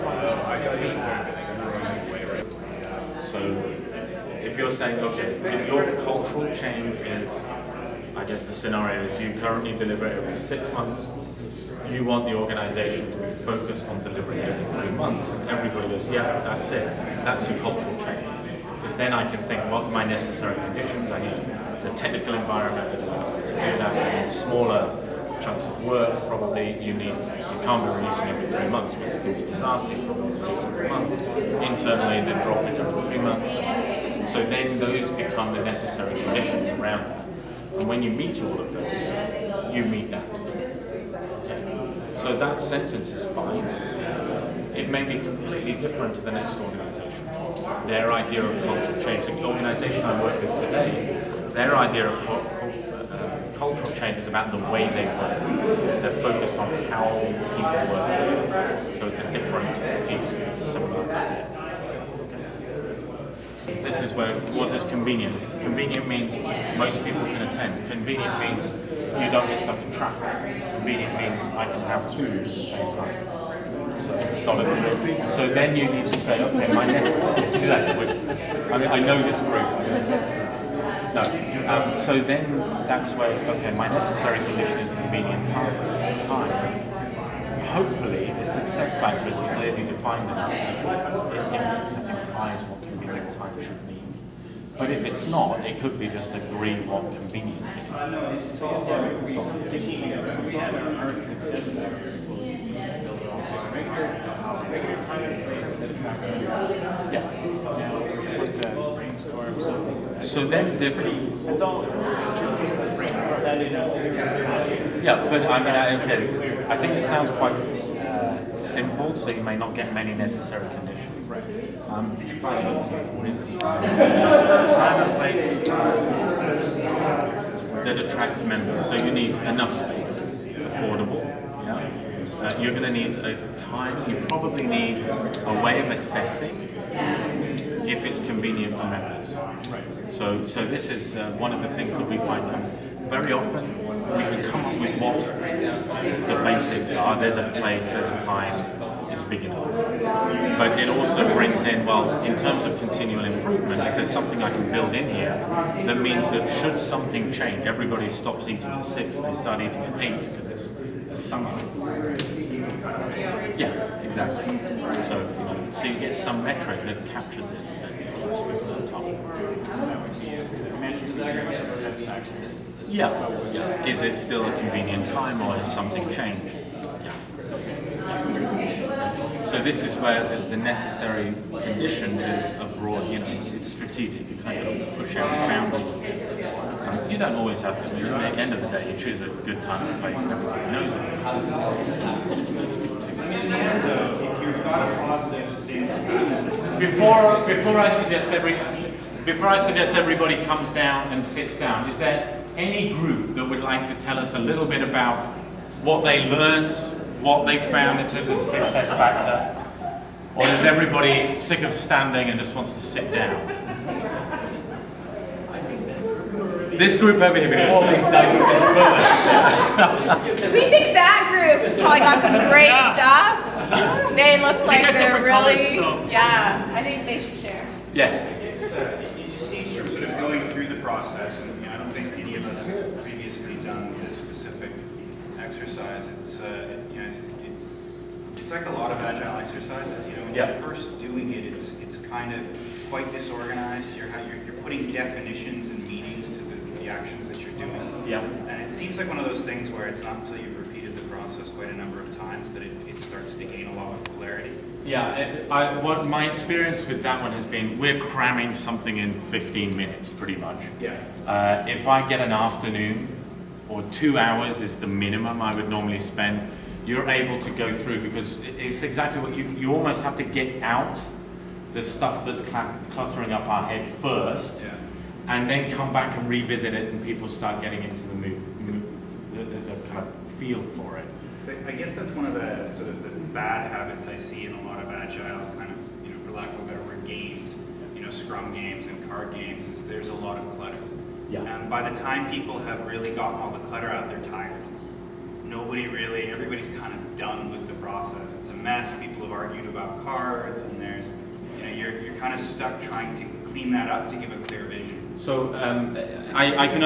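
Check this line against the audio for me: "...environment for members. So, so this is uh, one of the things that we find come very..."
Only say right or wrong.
wrong.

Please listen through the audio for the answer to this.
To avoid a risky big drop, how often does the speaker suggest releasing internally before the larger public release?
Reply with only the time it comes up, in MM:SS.
00:30.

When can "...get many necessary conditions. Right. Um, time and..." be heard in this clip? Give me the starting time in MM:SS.
01:59.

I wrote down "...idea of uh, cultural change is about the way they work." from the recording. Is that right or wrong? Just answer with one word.
right.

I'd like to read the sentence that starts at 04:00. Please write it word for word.
You know, when you're first doing it, it's it's kind of quite disorganized.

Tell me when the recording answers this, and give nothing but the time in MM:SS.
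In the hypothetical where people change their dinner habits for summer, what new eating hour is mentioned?
02:39.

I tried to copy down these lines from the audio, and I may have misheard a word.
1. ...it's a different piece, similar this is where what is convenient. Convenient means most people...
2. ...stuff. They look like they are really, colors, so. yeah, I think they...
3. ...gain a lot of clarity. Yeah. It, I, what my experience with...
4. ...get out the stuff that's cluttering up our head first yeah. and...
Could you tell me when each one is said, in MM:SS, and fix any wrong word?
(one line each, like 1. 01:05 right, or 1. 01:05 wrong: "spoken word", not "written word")
1. 00:59 right
2. 03:42 right
3. 04:13 right
4. 04:30 right.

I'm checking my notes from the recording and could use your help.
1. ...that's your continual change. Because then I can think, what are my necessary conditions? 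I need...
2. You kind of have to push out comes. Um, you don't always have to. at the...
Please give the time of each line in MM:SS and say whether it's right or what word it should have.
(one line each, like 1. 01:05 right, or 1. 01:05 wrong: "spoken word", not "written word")
1. 00:17 wrong: "cultural", not "continual"
2. 03:04 wrong: "boundaries", not "comes".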